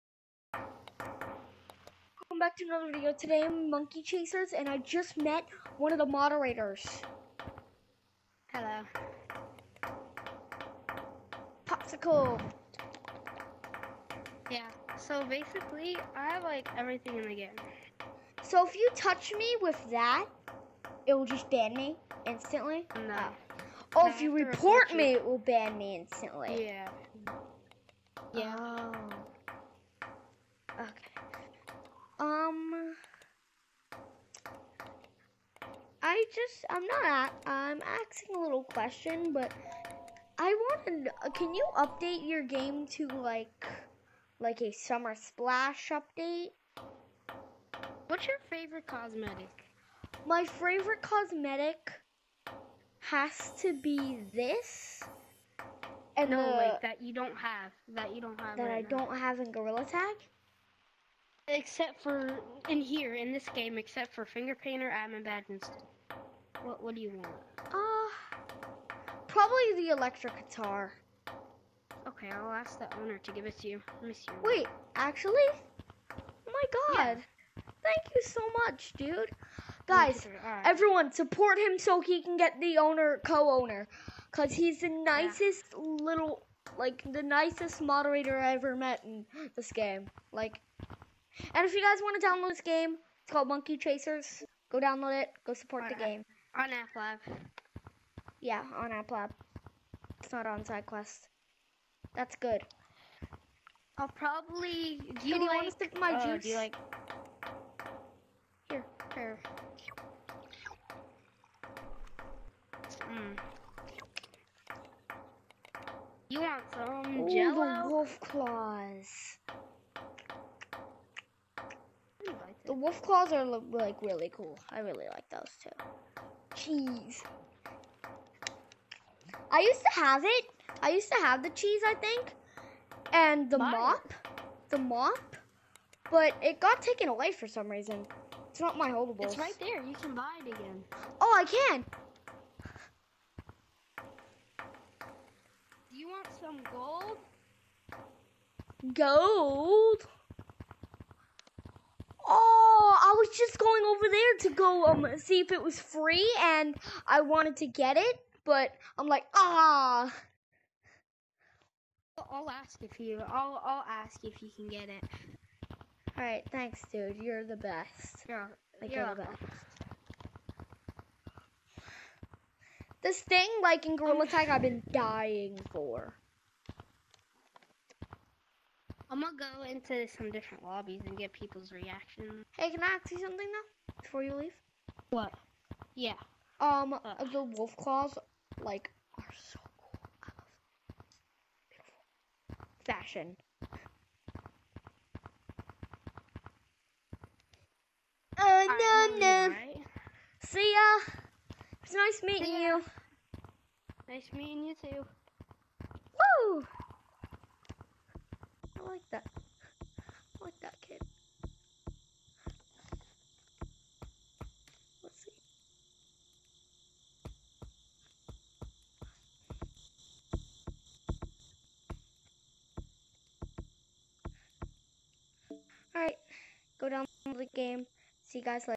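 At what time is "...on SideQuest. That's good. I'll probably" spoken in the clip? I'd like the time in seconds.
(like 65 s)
100 s.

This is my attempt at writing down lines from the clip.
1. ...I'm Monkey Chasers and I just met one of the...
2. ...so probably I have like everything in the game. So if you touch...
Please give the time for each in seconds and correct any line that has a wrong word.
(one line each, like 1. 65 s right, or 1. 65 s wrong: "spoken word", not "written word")
1. 3 s right
2. 14 s wrong: "basically", not "probably".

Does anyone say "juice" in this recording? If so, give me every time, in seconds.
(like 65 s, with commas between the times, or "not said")
106 s.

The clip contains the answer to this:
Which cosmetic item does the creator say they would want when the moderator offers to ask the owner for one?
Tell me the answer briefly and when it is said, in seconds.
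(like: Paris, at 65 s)
electric guitar, at 69 s.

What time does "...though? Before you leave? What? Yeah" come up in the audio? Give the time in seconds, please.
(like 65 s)
183 s.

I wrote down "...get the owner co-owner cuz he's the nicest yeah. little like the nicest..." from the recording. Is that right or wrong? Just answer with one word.
right.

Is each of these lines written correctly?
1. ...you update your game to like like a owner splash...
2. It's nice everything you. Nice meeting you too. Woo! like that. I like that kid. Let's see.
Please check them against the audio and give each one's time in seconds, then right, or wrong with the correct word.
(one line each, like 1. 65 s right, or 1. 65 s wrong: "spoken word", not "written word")
1. 41 s wrong: "summer", not "owner"
2. 201 s wrong: "meeting", not "everything".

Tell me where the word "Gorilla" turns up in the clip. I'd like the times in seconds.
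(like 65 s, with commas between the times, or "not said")
59 s, 173 s.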